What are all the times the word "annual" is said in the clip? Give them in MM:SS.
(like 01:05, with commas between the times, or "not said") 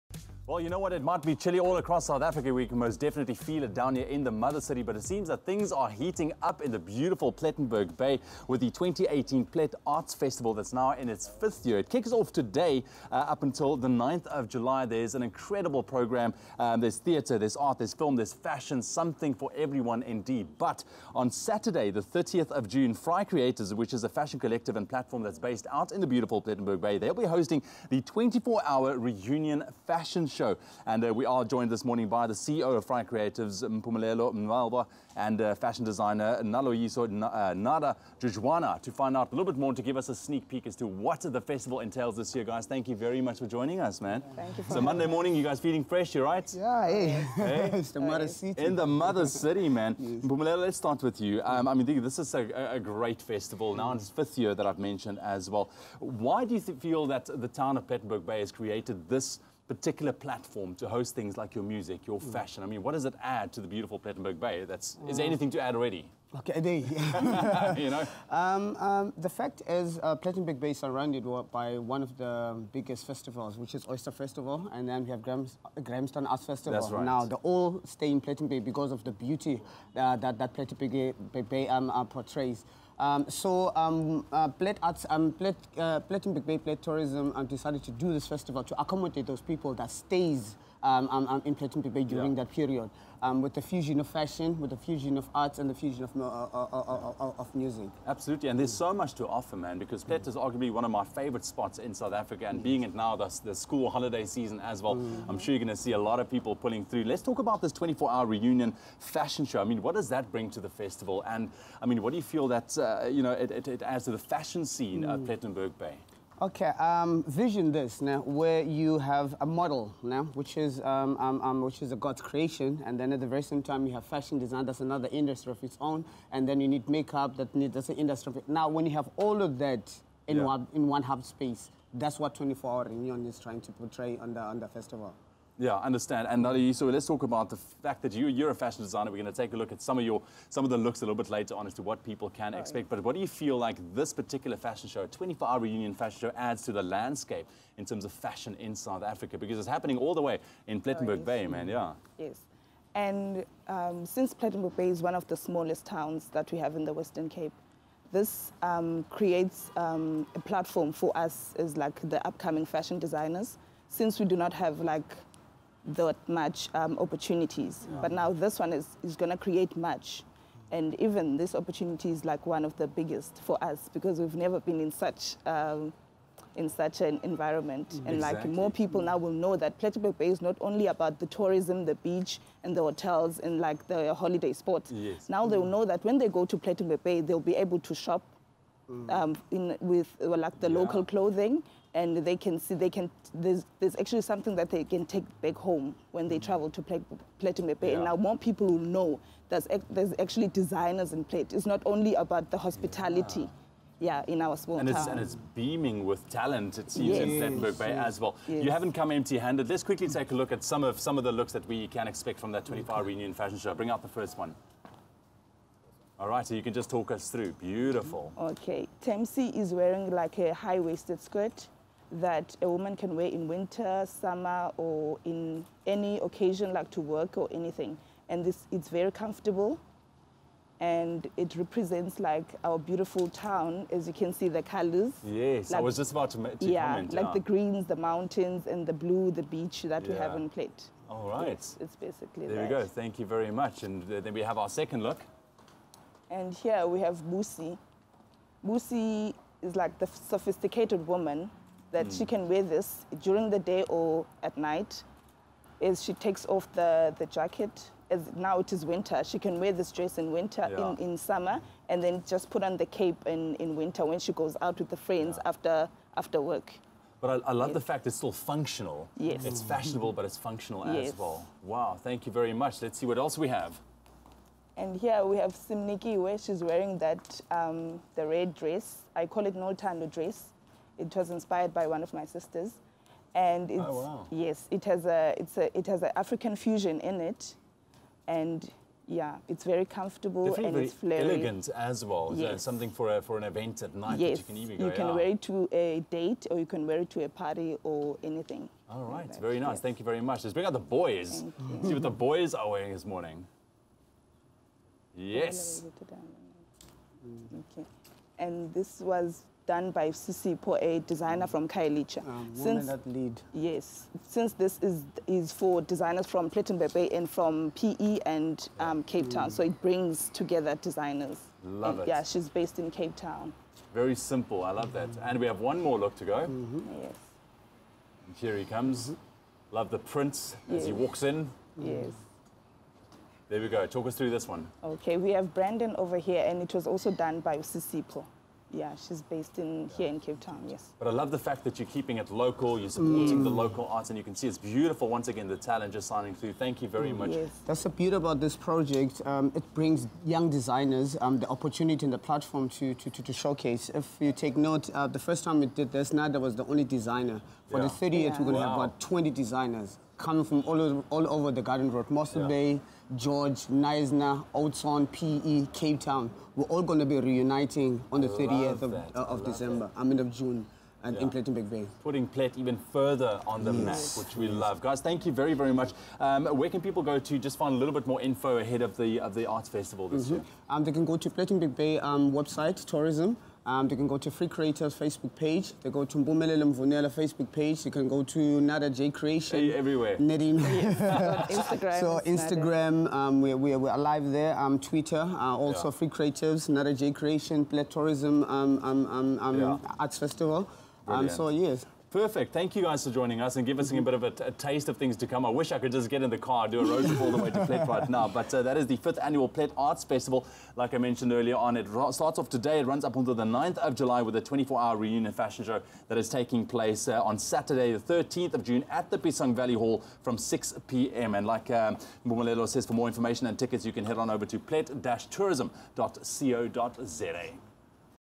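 06:49.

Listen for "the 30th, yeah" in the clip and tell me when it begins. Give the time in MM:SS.
05:57.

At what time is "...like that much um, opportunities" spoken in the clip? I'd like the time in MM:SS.
02:44.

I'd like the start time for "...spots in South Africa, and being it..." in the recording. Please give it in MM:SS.
01:41.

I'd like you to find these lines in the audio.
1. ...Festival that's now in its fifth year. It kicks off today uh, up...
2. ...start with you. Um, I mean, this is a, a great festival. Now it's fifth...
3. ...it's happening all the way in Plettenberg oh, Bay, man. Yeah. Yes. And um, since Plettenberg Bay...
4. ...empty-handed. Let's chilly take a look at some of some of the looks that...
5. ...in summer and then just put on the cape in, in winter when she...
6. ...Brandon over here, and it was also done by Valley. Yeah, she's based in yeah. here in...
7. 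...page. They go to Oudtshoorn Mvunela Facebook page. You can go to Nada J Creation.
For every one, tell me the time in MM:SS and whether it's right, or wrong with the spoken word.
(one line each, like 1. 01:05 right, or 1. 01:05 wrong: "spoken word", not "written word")
1. 00:10 right
2. 00:50 right
3. 02:29 right
4. 03:29 wrong: "quickly", not "chilly"
5. 04:20 right
6. 05:35 wrong: "Sisipo", not "Valley"
7. 06:25 wrong: "Mbumelele", not "Oudtshoorn".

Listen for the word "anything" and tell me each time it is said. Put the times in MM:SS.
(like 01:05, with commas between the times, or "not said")
01:05, 03:47, 04:58.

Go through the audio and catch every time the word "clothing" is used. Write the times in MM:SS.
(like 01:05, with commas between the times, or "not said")
03:11.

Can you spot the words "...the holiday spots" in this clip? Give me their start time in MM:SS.
03:03.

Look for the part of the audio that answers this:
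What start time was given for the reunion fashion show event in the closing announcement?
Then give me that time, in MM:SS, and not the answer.
07:00.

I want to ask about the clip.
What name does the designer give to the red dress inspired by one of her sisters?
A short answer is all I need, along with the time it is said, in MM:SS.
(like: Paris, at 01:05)
No Tando dress, at 04:39.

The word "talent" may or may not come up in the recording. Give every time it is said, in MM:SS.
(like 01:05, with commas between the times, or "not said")
03:26, 05:45.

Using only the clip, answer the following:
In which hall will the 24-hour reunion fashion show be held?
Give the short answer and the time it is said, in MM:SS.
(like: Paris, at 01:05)
Piesang Valley Hall, at 06:59.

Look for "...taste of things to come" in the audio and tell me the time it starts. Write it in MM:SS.
06:44.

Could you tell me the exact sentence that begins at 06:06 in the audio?
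We're all going to be reuniting on the 30th of, uh, of December, I mean of June.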